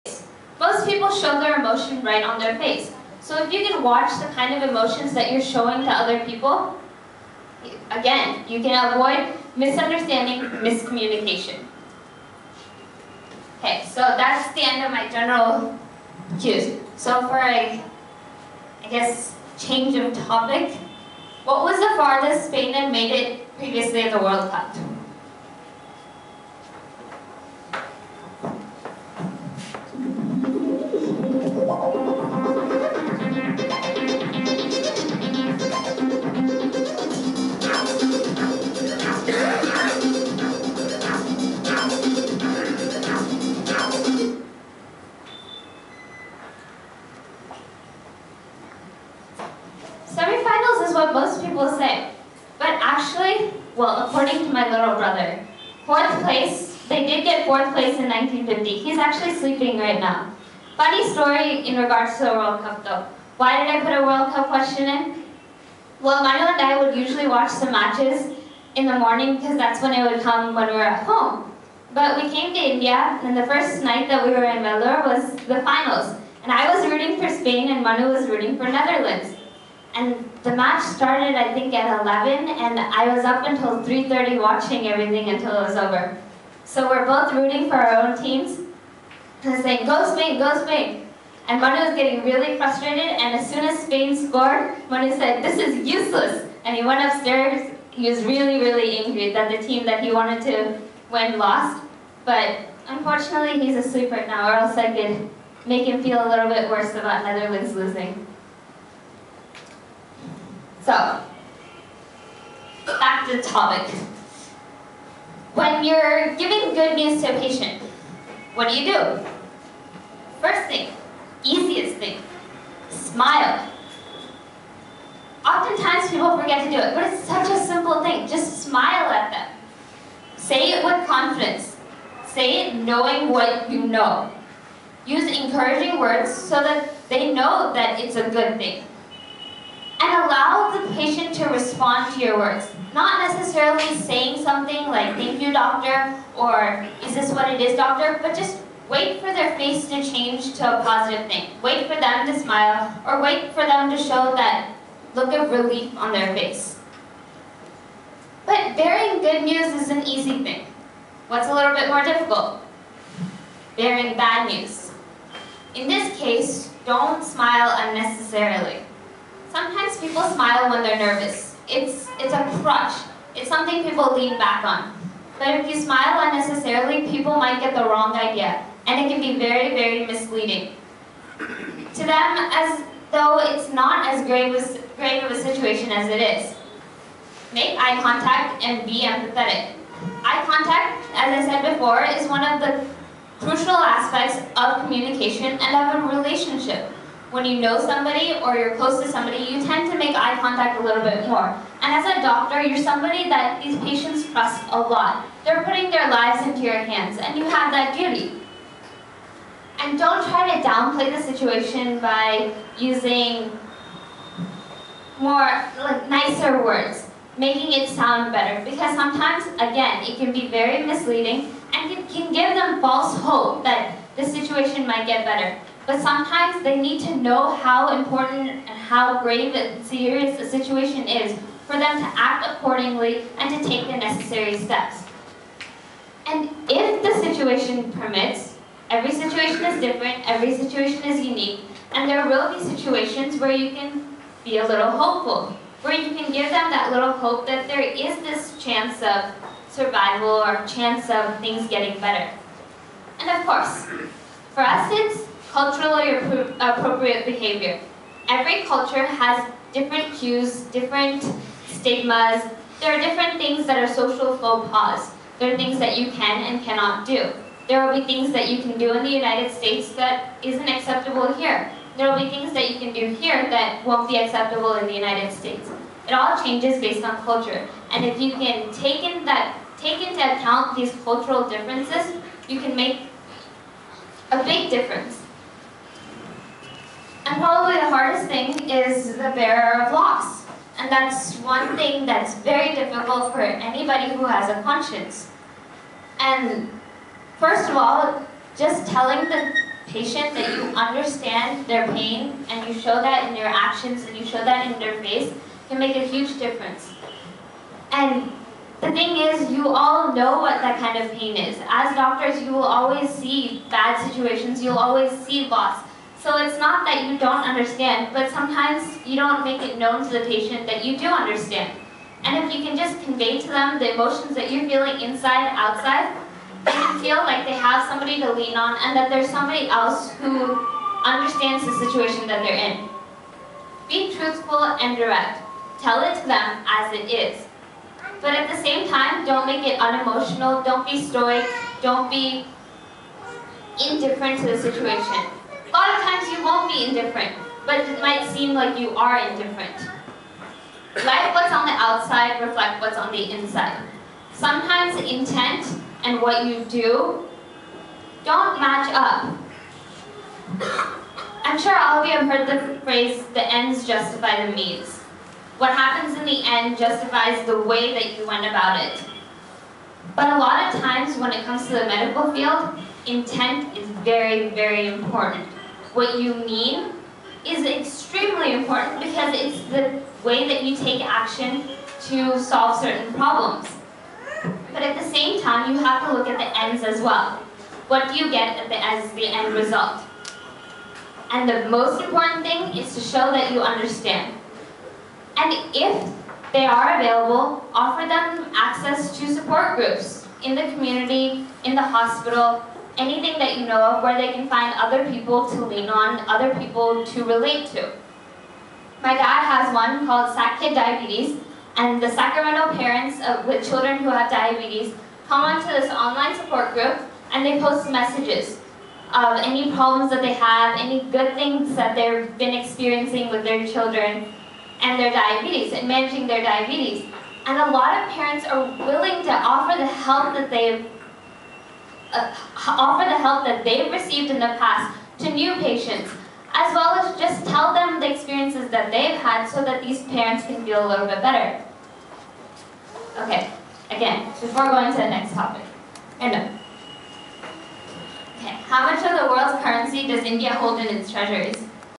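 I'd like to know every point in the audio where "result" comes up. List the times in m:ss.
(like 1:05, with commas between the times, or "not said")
6:29.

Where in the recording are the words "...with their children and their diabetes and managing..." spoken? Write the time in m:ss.
7:03.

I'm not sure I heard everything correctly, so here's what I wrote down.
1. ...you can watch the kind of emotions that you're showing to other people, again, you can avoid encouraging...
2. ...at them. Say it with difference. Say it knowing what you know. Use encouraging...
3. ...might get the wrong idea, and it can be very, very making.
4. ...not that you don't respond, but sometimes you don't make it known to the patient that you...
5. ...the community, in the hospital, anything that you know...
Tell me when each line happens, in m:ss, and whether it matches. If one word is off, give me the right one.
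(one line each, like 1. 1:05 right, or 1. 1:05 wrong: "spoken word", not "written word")
1. 0:03 wrong: "misunderstanding", not "encouraging"
2. 2:09 wrong: "confidence", not "difference"
3. 2:57 wrong: "misleading", not "making"
4. 5:16 wrong: "understand", not "respond"
5. 6:40 right.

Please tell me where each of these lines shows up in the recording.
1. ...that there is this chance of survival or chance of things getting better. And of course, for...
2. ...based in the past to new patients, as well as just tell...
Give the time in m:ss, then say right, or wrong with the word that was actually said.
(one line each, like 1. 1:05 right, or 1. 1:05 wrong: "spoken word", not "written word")
1. 4:07 right
2. 7:13 wrong: "received", not "based".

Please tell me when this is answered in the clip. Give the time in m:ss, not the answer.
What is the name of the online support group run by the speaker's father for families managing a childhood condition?
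6:50.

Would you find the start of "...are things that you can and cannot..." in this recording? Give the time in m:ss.
4:25.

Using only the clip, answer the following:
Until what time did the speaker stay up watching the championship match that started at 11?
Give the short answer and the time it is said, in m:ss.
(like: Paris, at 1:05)
3:30, at 1:23.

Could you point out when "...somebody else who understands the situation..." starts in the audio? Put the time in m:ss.
5:29.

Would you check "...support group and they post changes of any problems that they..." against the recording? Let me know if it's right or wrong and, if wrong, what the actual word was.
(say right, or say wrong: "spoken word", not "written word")
wrong: "messages", not "changes".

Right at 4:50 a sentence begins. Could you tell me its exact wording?
And that's one thing that's very difficult for anybody who has a conscience.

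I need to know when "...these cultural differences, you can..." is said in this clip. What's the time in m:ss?
4:40.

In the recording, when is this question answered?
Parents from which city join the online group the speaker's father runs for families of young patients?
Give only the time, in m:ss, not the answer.
6:52.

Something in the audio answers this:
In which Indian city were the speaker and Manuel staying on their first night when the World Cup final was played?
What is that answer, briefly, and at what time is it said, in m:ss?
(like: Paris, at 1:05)
Vellore, at 1:14.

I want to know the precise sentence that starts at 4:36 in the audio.
It all changes based on culture.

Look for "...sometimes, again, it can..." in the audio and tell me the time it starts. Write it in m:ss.
3:38.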